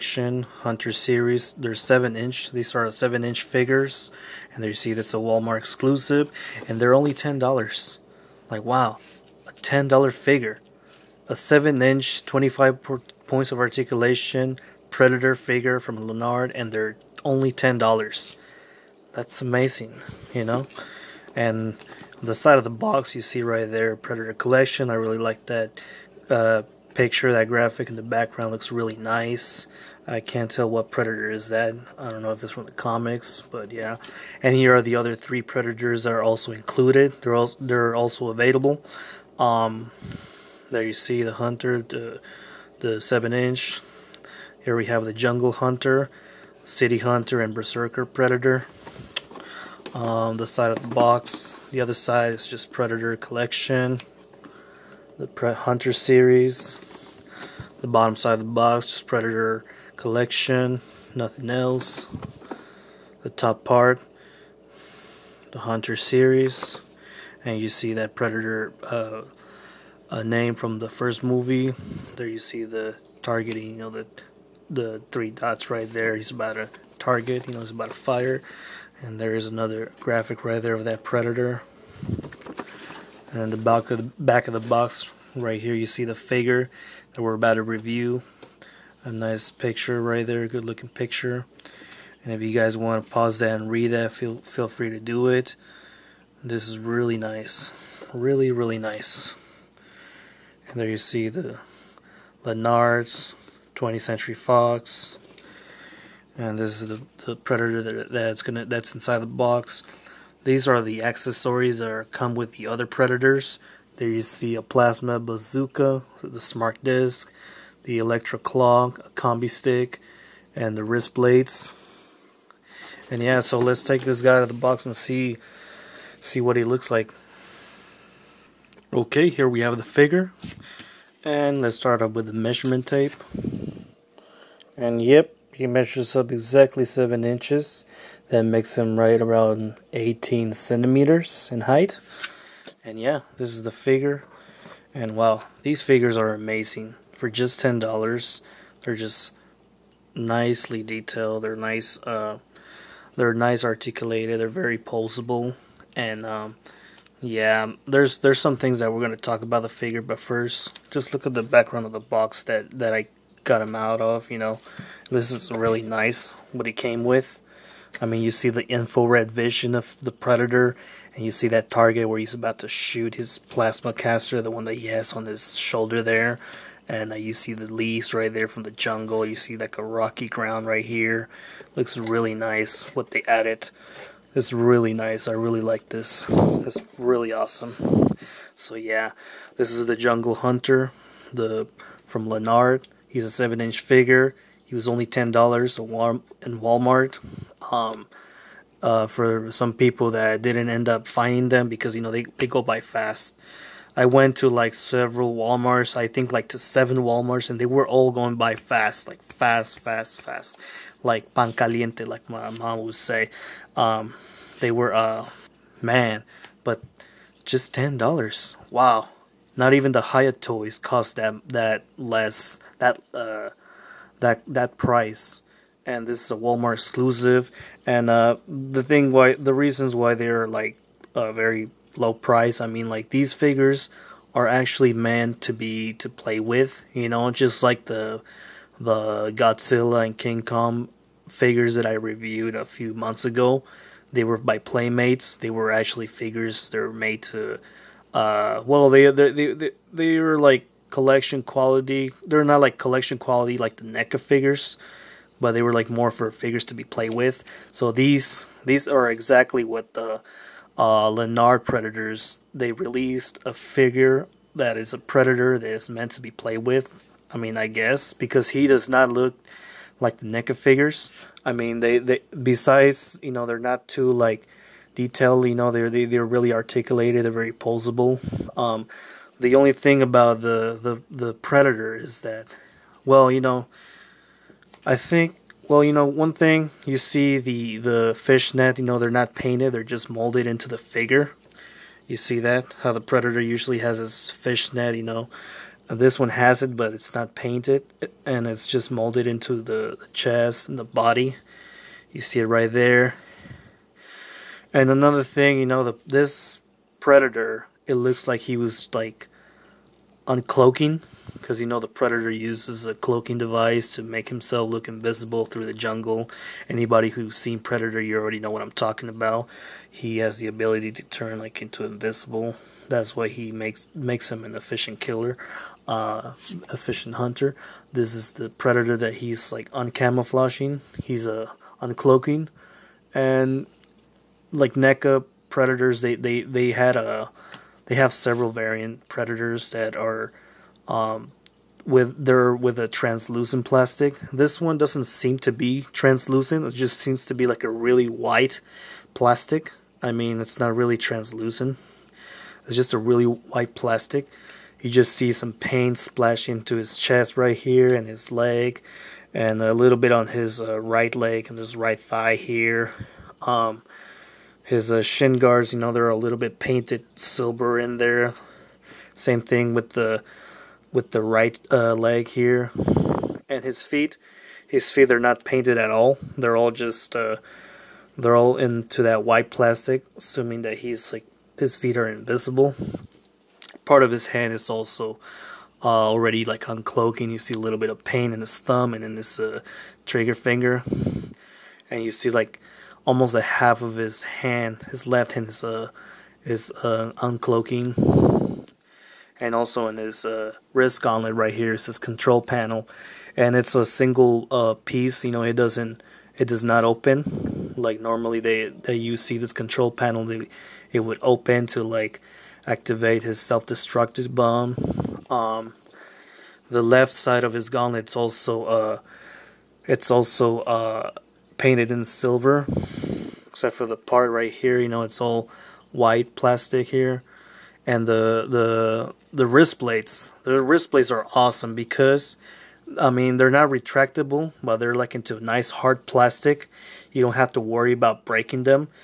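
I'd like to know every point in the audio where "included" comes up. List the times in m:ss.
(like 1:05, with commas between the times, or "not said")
0:36.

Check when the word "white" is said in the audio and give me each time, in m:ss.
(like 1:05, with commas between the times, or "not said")
5:48, 5:53, 6:19, 7:05.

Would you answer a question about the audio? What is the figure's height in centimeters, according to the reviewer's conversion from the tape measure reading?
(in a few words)
18 centimeters.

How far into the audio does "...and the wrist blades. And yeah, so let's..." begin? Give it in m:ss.
2:00.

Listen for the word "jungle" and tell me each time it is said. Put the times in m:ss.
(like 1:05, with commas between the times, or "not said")
0:45, 2:58, 3:09, 5:15.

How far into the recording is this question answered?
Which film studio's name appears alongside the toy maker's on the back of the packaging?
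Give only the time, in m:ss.
1:43.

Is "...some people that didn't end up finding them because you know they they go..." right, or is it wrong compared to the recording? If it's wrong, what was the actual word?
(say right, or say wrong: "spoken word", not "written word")
right.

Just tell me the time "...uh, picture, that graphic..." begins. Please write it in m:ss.
0:26.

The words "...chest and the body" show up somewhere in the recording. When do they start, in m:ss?
5:00.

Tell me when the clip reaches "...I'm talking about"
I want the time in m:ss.
5:18.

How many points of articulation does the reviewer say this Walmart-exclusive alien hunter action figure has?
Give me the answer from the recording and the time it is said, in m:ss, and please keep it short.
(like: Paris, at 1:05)
25, at 0:12.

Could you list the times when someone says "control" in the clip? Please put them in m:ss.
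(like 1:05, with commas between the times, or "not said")
6:41, 6:49.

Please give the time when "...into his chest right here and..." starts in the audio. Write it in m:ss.
5:56.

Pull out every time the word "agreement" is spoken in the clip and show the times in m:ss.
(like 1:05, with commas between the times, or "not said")
not said.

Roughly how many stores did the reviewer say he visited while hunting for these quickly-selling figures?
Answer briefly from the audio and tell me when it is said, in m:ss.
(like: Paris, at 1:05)
7 Walmarts, at 3:26.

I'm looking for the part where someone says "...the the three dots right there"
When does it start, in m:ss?
1:13.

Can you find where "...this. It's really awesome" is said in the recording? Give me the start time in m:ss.
3:05.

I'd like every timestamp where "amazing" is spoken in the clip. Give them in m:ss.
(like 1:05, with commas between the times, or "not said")
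0:19, 2:26.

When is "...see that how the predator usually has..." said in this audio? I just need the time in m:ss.
4:52.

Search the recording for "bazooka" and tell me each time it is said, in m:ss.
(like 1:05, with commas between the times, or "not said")
1:55.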